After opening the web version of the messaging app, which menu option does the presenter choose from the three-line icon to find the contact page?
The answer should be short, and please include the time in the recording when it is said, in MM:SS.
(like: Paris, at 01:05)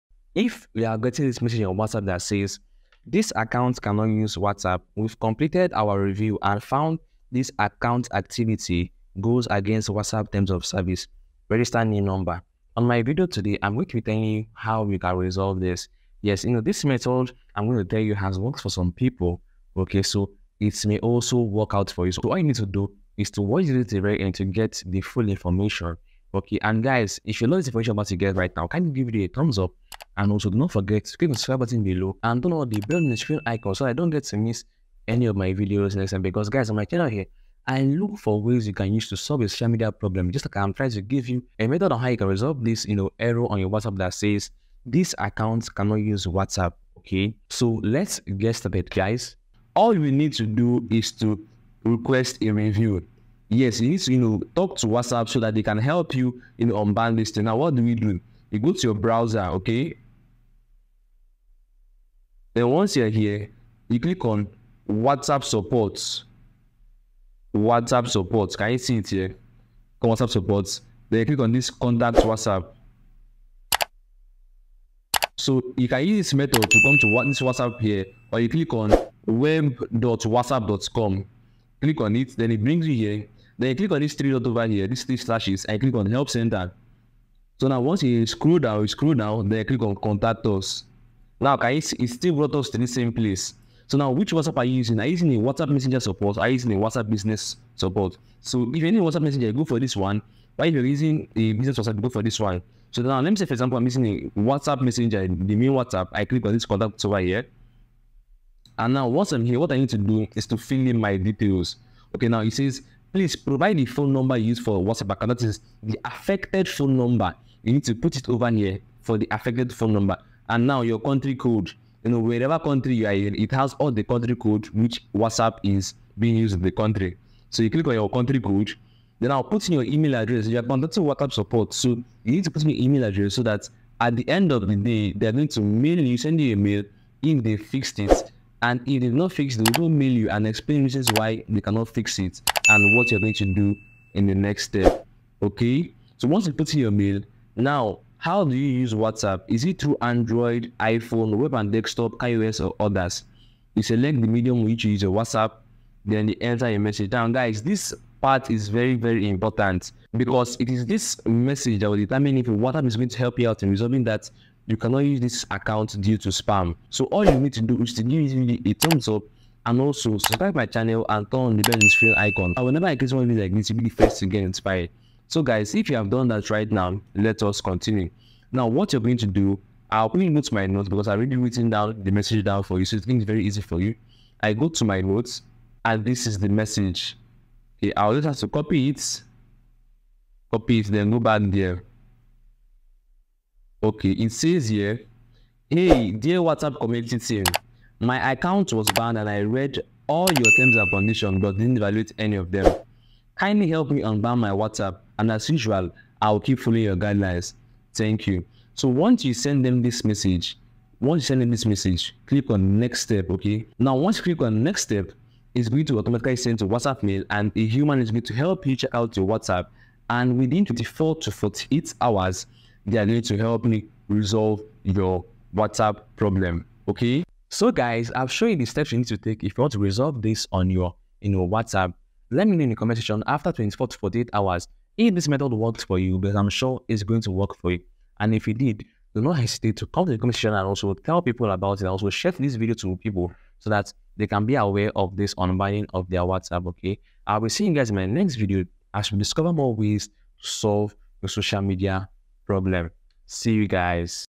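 Help Center, at 01:26.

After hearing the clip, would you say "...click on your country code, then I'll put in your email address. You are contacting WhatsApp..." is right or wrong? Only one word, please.
right.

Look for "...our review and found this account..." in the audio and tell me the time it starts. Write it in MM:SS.
00:05.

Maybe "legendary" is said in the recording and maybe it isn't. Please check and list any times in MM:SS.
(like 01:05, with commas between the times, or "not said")
not said.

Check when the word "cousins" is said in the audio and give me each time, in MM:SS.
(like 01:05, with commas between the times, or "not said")
not said.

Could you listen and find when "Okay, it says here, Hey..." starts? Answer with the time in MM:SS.
03:13.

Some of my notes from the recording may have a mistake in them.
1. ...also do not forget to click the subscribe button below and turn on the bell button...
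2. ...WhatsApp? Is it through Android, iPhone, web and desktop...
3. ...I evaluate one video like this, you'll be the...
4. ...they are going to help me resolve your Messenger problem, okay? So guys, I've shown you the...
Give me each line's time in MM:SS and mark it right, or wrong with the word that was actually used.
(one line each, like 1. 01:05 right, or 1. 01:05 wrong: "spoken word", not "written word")
1. 00:30 wrong: "notification", not "button"
2. 02:28 right
3. 02:52 wrong: "create", not "evaluate"
4. 03:42 wrong: "WhatsApp", not "Messenger".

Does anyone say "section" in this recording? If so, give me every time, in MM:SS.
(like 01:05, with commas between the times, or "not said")
03:52, 04:00.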